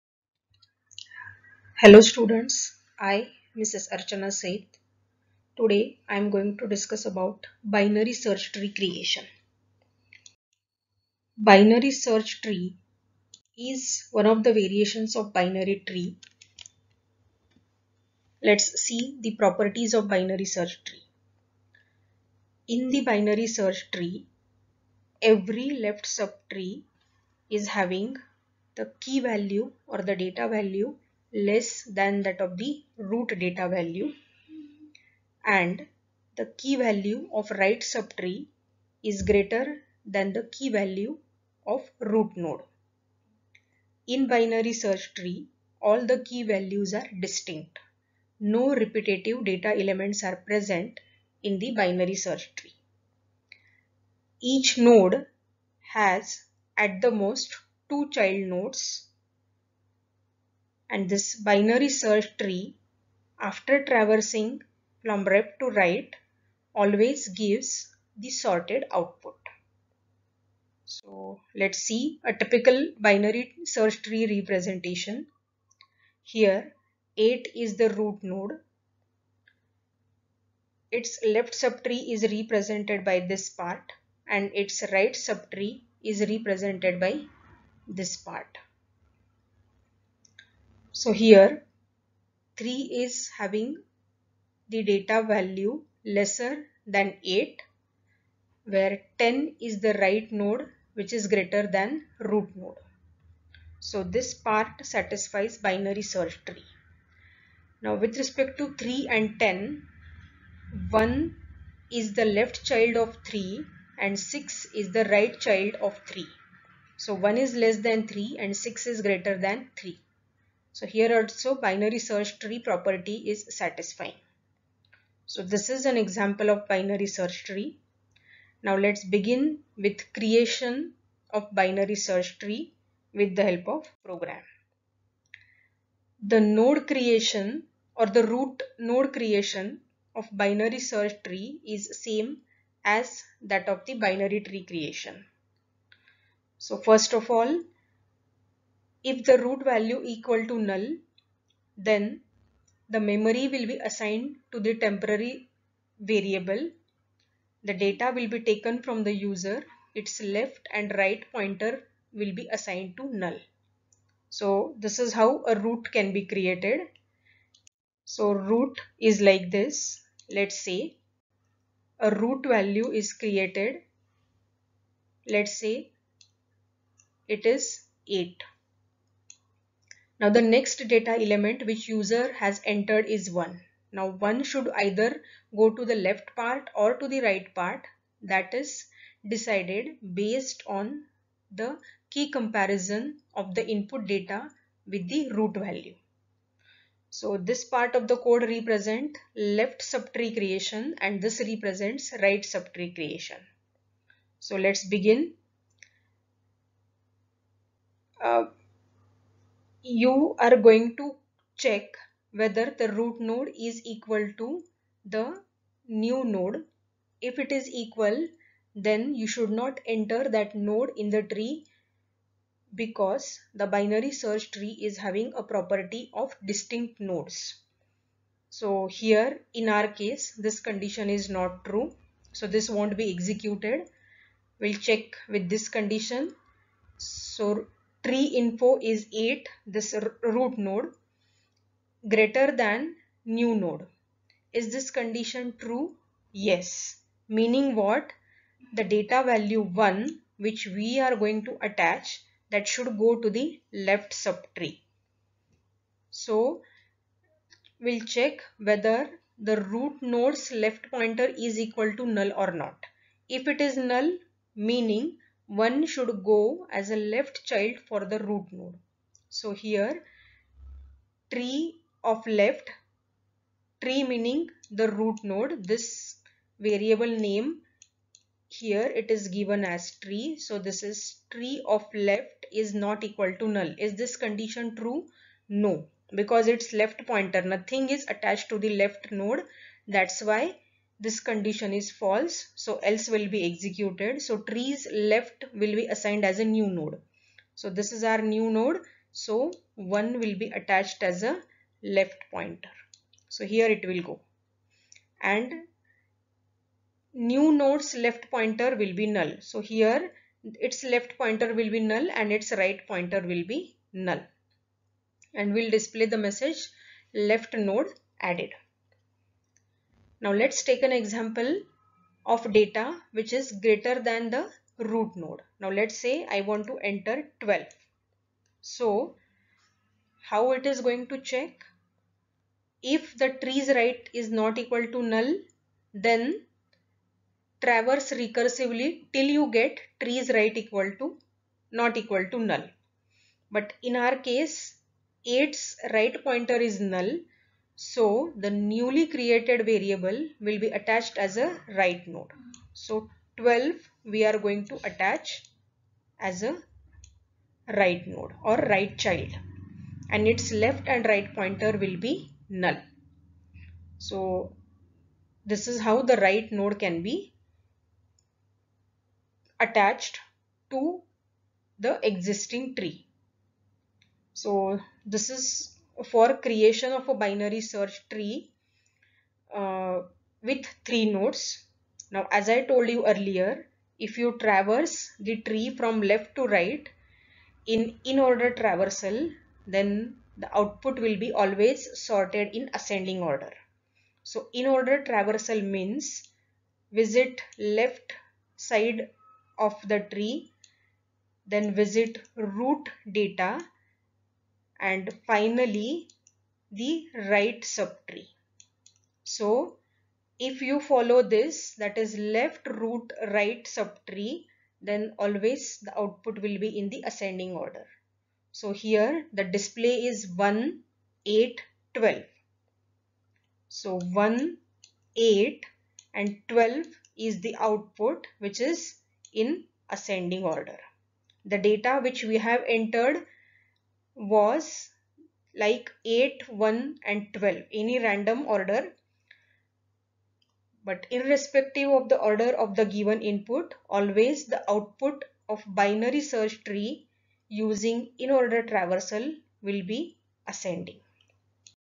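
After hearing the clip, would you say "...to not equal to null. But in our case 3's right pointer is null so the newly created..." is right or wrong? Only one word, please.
wrong.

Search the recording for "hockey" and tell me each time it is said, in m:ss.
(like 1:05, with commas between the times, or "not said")
not said.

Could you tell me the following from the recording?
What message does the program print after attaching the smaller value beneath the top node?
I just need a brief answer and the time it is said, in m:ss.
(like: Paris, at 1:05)
left node added, at 5:17.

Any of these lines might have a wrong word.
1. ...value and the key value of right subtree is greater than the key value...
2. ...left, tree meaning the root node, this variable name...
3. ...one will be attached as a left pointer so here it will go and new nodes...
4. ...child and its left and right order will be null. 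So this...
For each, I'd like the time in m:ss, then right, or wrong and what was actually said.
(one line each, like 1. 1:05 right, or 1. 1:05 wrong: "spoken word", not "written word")
1. 0:33 right
2. 4:32 right
3. 4:59 right
4. 5:58 wrong: "pointer", not "order".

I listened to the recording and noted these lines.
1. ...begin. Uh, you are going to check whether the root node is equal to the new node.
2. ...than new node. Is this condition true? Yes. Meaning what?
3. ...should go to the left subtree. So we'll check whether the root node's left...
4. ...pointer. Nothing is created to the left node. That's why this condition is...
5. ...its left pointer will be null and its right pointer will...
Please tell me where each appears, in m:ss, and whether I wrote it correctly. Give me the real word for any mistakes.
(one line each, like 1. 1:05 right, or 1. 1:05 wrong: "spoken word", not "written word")
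1. 3:24 right
2. 4:02 right
3. 4:12 right
4. 4:47 wrong: "attached", not "created"
5. 5:10 right.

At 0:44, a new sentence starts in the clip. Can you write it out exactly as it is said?
In binary search tree, all the key values are distinct.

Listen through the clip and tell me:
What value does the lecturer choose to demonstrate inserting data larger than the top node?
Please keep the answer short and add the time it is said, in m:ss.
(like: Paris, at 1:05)
12, at 5:26.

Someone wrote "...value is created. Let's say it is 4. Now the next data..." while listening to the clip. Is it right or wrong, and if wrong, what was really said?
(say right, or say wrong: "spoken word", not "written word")
wrong: "8", not "4".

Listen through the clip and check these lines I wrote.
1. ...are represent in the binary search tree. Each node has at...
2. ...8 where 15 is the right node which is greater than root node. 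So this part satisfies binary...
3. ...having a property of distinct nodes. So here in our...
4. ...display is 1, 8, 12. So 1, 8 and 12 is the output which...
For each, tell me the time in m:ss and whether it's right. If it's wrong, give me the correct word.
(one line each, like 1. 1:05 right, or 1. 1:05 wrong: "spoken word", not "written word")
1. 0:50 wrong: "present", not "represent"
2. 1:37 wrong: "10", not "15"
3. 3:44 right
4. 6:59 right.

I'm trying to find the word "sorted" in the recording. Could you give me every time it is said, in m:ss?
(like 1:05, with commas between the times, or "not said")
1:08, 6:31.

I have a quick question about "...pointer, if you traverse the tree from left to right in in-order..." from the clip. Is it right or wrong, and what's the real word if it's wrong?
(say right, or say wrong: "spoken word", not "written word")
wrong: "earlier", not "pointer".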